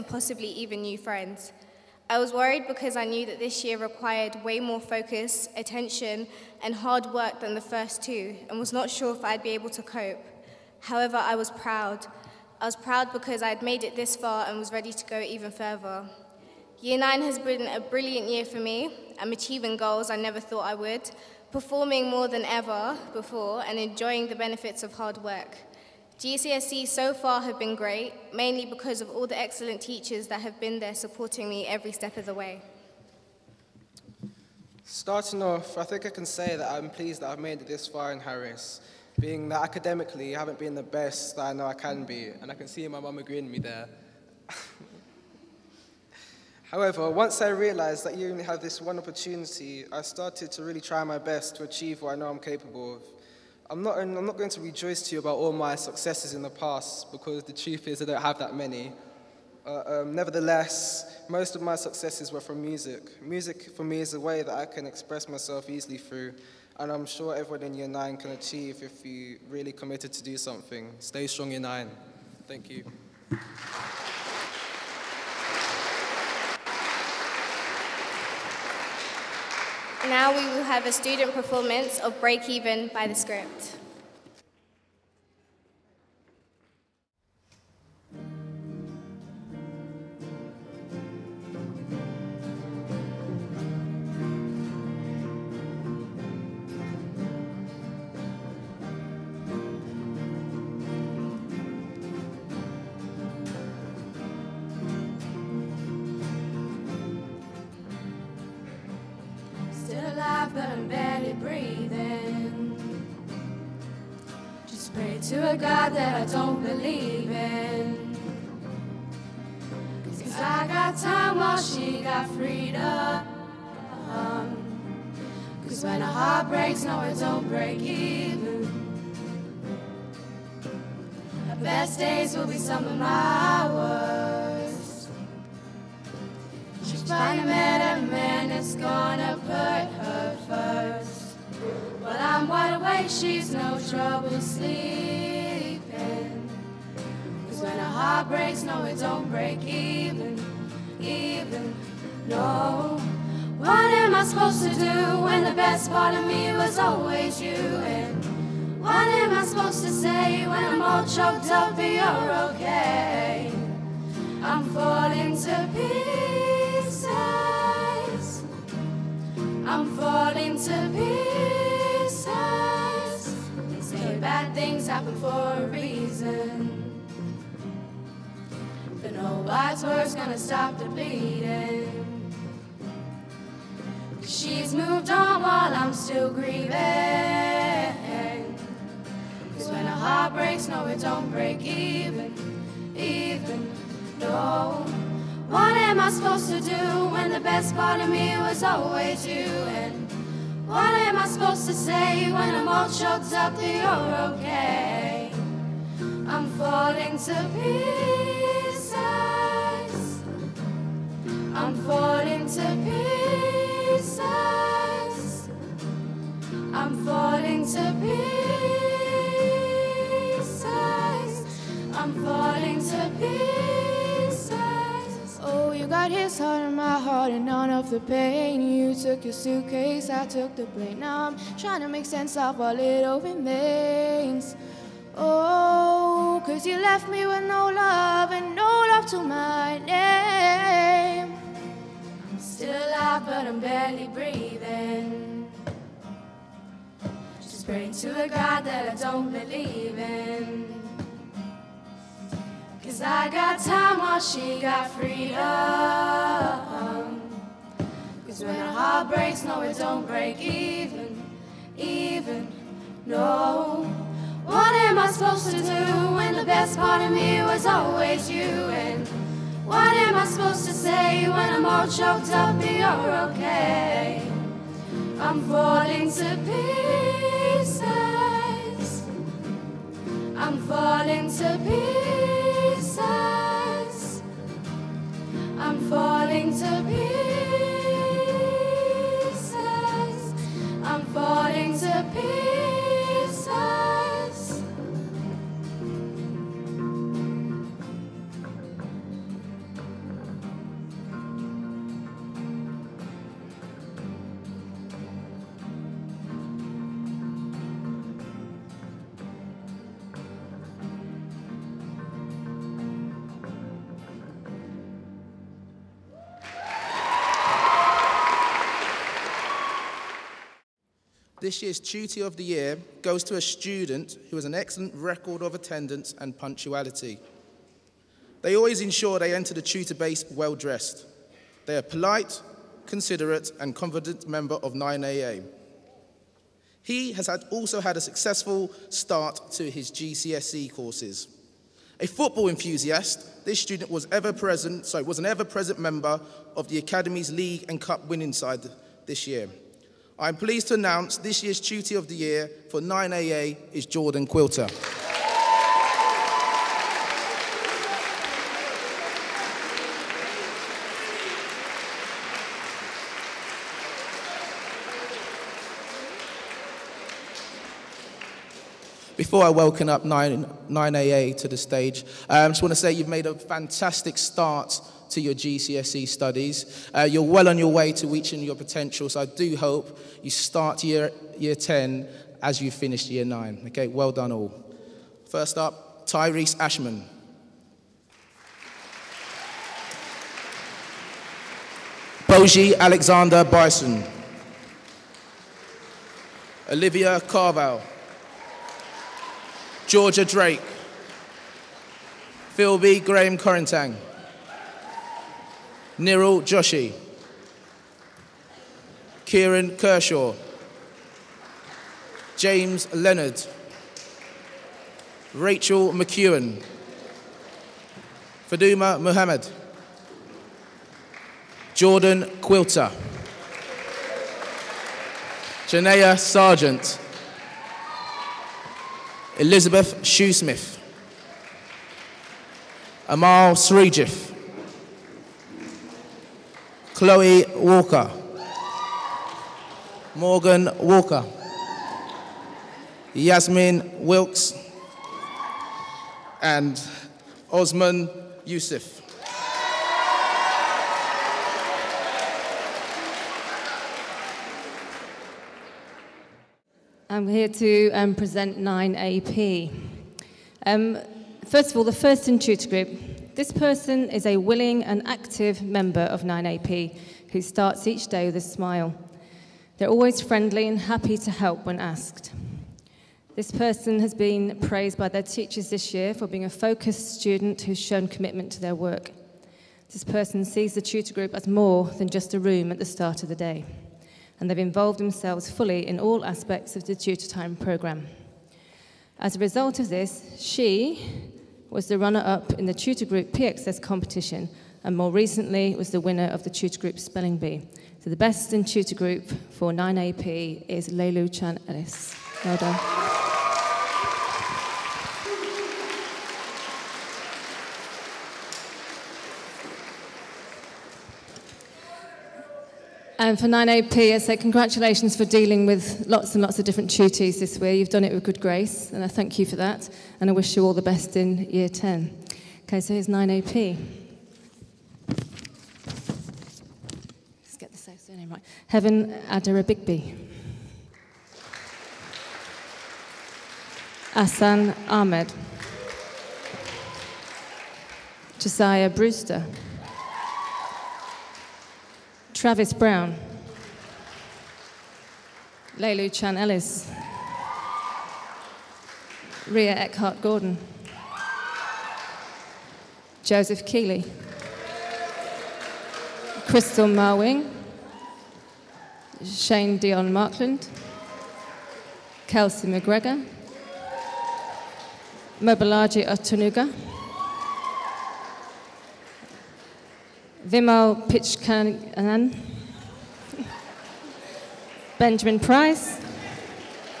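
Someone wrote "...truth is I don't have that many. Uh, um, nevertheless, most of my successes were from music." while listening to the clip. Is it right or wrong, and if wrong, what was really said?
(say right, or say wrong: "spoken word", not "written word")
right.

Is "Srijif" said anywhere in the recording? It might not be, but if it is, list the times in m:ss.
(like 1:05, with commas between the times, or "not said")
7:13.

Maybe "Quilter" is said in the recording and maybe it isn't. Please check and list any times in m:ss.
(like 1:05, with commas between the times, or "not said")
5:54, 7:02.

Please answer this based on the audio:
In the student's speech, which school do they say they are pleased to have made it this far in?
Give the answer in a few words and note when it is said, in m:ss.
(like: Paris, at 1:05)
Harris, at 0:38.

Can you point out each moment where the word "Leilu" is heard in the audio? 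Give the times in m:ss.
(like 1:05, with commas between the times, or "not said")
8:20, 9:05.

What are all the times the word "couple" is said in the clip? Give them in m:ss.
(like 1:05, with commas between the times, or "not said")
not said.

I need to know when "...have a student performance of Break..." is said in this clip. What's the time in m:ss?
1:20.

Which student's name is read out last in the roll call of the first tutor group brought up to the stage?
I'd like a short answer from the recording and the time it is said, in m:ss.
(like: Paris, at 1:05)
Osman Yusuf, at 7:27.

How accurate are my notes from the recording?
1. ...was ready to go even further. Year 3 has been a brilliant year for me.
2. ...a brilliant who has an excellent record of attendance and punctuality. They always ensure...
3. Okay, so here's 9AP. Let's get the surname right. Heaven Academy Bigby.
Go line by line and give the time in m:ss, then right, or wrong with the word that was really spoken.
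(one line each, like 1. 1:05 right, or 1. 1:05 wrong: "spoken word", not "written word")
1. 0:14 wrong: "9", not "3"
2. 5:23 wrong: "student", not "brilliant"
3. 8:42 wrong: "Adara", not "Academy".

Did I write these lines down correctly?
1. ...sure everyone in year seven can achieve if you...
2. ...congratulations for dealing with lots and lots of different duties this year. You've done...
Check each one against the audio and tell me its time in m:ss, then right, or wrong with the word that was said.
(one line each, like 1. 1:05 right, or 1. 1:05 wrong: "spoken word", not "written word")
1. 1:07 wrong: "nine", not "seven"
2. 8:34 right.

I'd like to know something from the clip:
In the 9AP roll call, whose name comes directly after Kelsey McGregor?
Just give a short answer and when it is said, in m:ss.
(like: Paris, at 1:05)
Mobalaji Otunuga, at 9:25.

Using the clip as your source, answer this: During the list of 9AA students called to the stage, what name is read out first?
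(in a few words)
Tyrese Ashman.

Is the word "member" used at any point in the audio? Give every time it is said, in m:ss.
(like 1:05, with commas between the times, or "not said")
5:34, 5:45, 7:45.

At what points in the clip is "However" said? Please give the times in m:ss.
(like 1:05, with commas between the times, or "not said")
0:10, 0:46.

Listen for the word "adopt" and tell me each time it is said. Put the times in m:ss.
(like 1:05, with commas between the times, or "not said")
not said.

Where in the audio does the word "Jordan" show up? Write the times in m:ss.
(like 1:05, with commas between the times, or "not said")
5:53, 7:01.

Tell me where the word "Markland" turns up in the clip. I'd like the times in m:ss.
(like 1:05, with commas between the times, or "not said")
9:20.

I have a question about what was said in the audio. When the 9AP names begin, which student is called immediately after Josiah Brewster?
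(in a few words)
Travis Brown.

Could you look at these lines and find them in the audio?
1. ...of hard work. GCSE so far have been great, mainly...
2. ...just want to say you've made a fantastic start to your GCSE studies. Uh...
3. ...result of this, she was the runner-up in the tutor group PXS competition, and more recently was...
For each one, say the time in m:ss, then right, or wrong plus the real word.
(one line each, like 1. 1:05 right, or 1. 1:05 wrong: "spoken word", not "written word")
1. 0:24 right
2. 6:12 right
3. 8:09 right.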